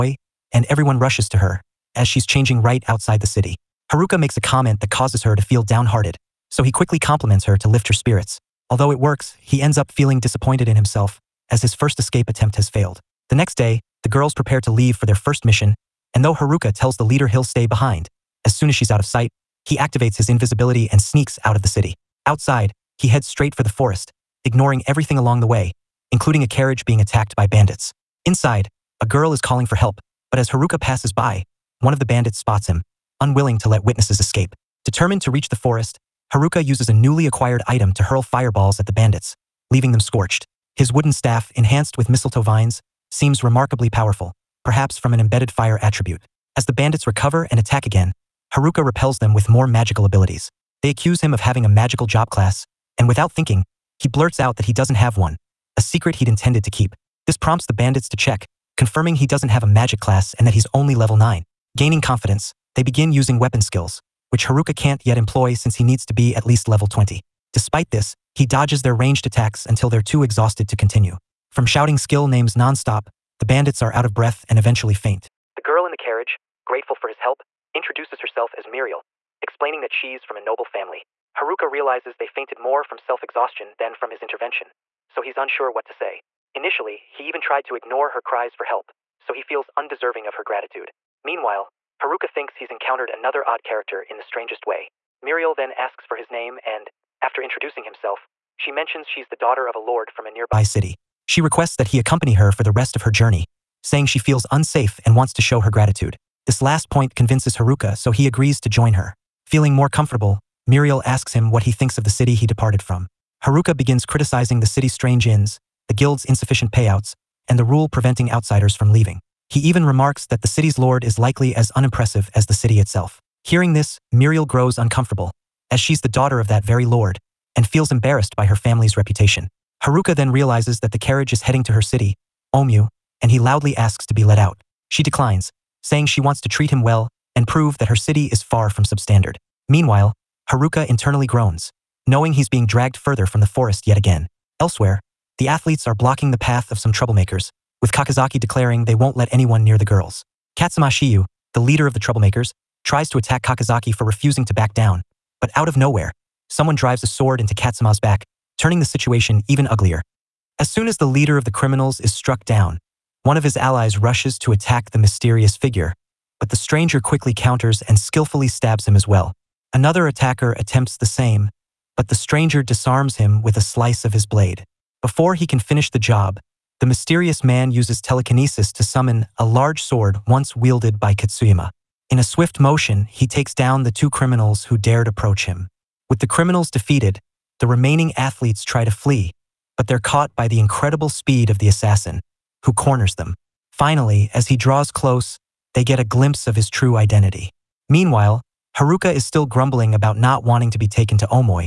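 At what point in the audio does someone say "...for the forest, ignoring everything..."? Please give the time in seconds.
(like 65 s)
23 s.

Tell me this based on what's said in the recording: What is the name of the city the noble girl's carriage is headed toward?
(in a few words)
Omu.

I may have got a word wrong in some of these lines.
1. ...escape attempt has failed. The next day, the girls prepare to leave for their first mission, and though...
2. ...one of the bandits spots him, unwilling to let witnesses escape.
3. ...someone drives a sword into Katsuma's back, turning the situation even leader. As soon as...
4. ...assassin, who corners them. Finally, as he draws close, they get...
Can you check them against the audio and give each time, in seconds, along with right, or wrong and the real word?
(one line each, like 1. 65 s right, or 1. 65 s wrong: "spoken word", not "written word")
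1. 11 s right
2. 31 s right
3. 156 s wrong: "uglier", not "leader"
4. 191 s right.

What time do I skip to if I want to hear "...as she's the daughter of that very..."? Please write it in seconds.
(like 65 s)
125 s.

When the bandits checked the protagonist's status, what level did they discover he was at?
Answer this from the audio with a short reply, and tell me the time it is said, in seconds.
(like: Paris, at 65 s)
9, at 60 s.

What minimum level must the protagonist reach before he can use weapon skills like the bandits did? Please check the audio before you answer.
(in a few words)
20.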